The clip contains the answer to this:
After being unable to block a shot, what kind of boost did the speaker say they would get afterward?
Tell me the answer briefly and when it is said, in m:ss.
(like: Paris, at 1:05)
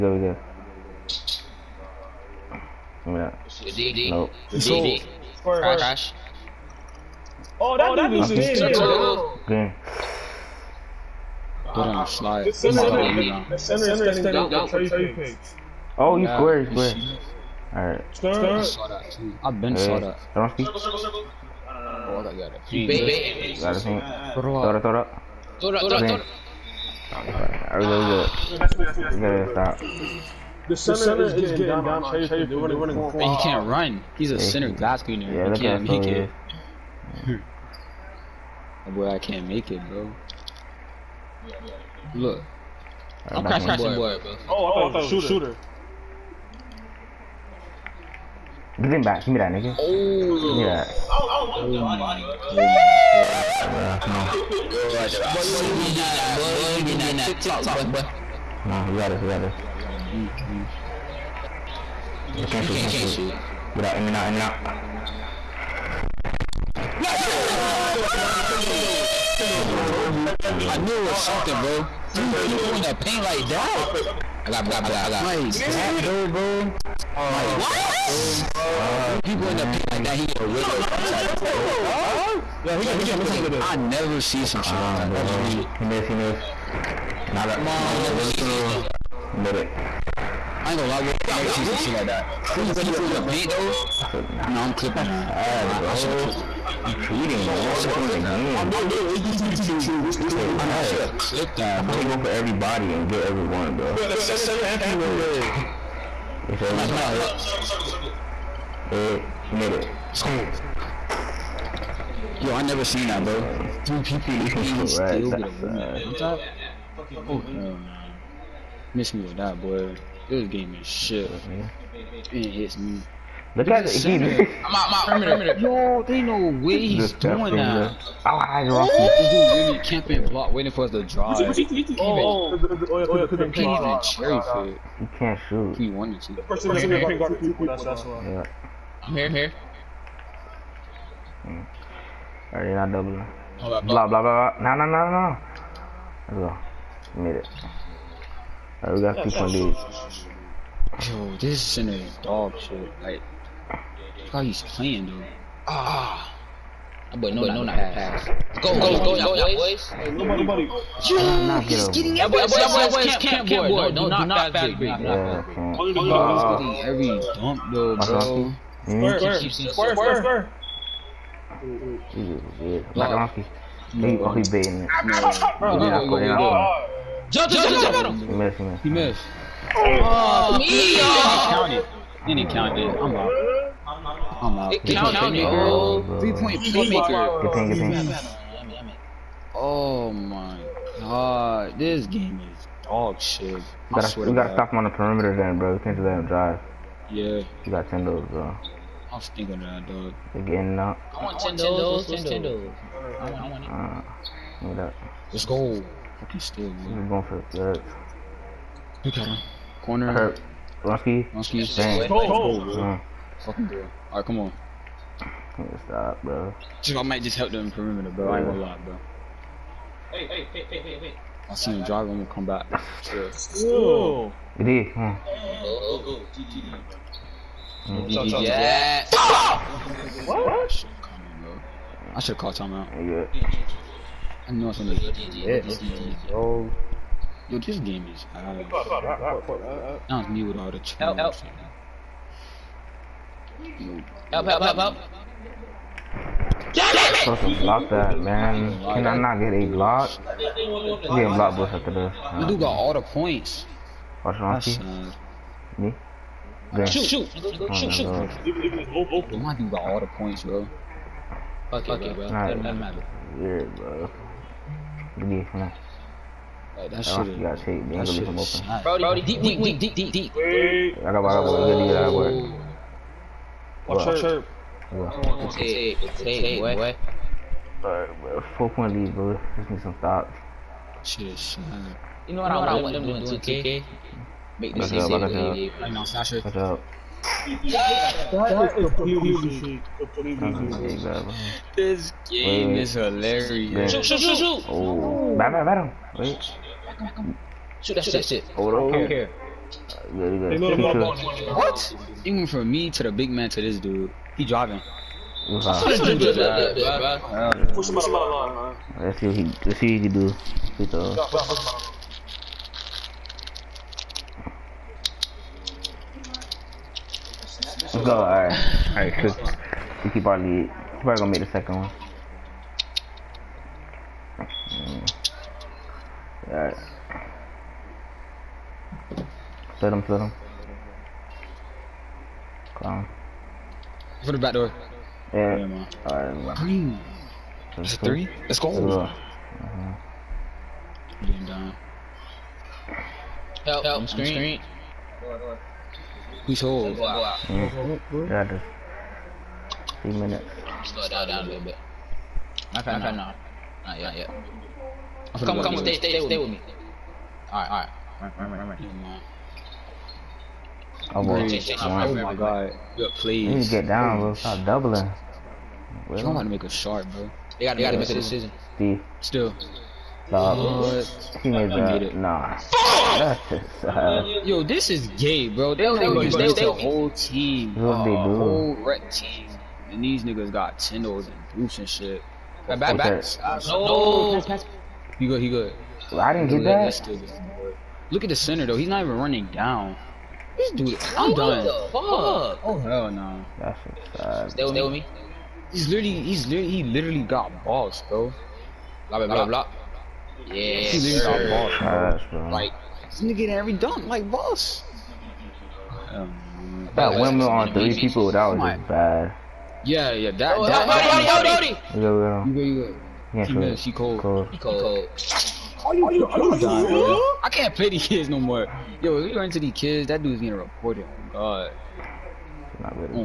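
Block boost, at 4:11.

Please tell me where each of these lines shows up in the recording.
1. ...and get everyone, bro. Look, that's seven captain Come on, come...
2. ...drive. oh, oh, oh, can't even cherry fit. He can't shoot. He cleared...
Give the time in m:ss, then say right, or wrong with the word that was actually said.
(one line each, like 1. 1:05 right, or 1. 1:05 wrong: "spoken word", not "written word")
1. 1:42 right
2. 2:11 wrong: "wanted", not "cleared".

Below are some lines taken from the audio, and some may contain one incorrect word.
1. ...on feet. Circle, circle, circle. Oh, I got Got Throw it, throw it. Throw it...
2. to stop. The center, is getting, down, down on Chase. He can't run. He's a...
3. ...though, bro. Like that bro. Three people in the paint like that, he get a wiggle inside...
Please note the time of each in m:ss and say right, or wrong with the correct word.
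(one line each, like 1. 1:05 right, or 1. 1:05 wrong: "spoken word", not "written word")
1. 0:20 right
2. 0:29 right
3. 1:16 right.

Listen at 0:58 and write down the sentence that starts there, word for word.
Come on, we got this, we got this.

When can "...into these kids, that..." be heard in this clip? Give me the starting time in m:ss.
6:59.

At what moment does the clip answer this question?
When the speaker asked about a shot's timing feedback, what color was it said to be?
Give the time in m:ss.
5:38.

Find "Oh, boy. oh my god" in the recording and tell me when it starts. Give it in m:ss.
6:01.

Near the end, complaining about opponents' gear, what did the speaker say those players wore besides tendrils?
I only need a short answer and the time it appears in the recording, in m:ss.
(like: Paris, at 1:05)
Boots, at 6:21.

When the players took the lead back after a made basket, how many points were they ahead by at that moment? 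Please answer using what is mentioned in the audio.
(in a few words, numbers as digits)
2.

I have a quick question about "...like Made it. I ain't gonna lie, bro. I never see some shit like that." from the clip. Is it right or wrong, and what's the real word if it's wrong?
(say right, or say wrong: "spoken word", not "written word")
right.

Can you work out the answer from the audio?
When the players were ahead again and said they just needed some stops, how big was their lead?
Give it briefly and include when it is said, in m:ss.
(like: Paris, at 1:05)
4 points, at 4:38.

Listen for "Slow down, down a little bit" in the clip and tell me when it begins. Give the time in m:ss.
5:50.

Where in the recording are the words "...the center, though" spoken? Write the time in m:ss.
6:28.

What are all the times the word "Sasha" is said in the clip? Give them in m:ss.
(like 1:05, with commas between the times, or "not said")
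4:46.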